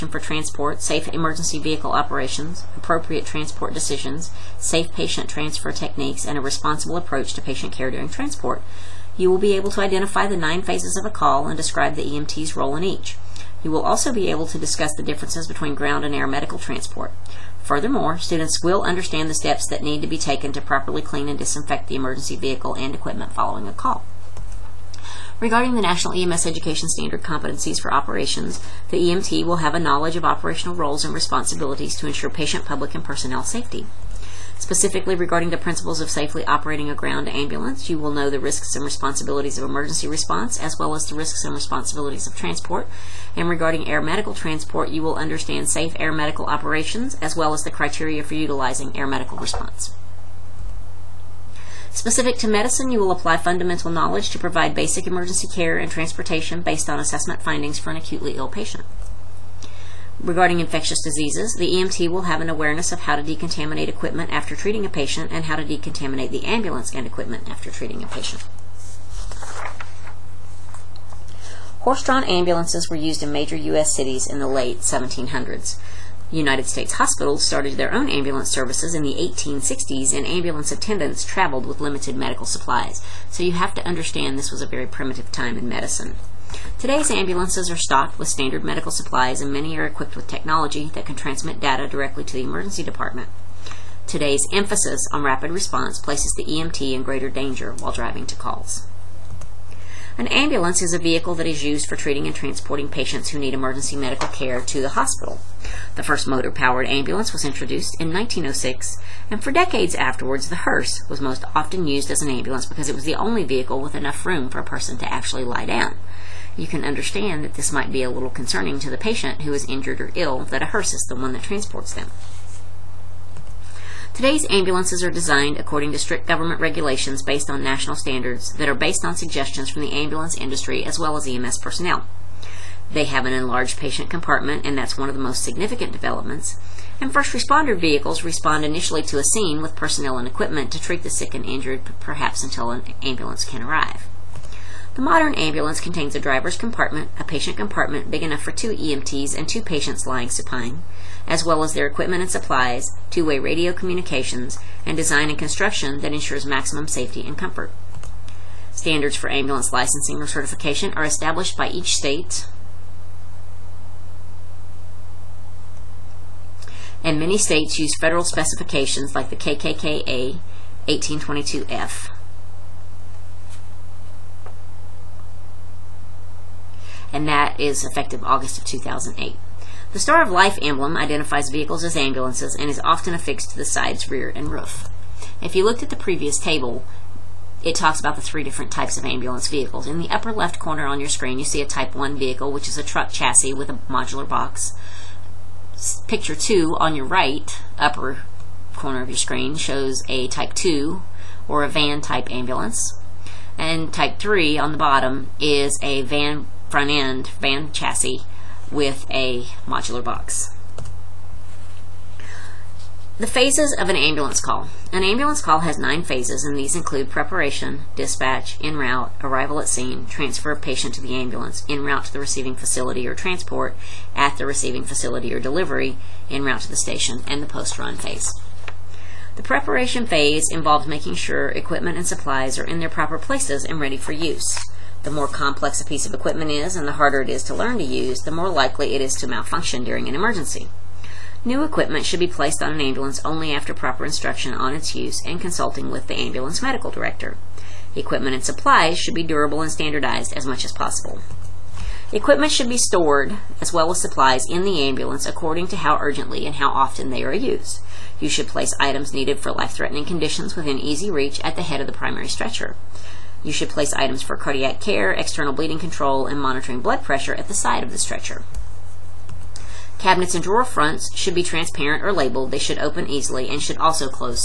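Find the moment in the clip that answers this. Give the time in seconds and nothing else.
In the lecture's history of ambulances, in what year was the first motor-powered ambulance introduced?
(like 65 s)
108 s.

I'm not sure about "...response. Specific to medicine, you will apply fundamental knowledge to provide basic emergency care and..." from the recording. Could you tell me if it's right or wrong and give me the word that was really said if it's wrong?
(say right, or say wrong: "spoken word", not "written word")
right.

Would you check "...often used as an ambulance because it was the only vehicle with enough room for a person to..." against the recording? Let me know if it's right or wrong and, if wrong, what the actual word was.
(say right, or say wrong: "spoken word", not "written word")
right.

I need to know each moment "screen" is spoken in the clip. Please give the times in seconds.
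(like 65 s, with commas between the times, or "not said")
191 s, 199 s.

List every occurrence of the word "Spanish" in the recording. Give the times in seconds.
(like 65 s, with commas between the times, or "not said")
not said.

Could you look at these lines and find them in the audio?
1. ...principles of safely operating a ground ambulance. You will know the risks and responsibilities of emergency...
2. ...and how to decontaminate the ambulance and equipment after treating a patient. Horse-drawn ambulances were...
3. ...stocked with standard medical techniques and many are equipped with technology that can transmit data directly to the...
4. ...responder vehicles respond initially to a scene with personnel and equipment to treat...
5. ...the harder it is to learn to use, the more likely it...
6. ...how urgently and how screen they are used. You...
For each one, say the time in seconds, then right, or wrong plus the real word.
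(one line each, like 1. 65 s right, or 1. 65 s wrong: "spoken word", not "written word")
1. 35 s right
2. 65 s right
3. 87 s wrong: "supplies", not "techniques"
4. 137 s right
5. 236 s right
6. 255 s wrong: "often", not "screen".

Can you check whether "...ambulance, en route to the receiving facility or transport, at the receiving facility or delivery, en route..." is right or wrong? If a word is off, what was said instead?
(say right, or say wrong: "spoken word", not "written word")
right.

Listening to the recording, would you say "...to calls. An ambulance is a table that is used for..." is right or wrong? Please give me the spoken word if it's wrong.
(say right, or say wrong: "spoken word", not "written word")
wrong: "vehicle", not "table".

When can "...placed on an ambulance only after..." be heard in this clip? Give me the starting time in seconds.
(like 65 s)
242 s.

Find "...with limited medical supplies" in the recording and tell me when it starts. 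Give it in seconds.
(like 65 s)
81 s.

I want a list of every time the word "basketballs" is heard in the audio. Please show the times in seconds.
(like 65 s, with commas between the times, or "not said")
not said.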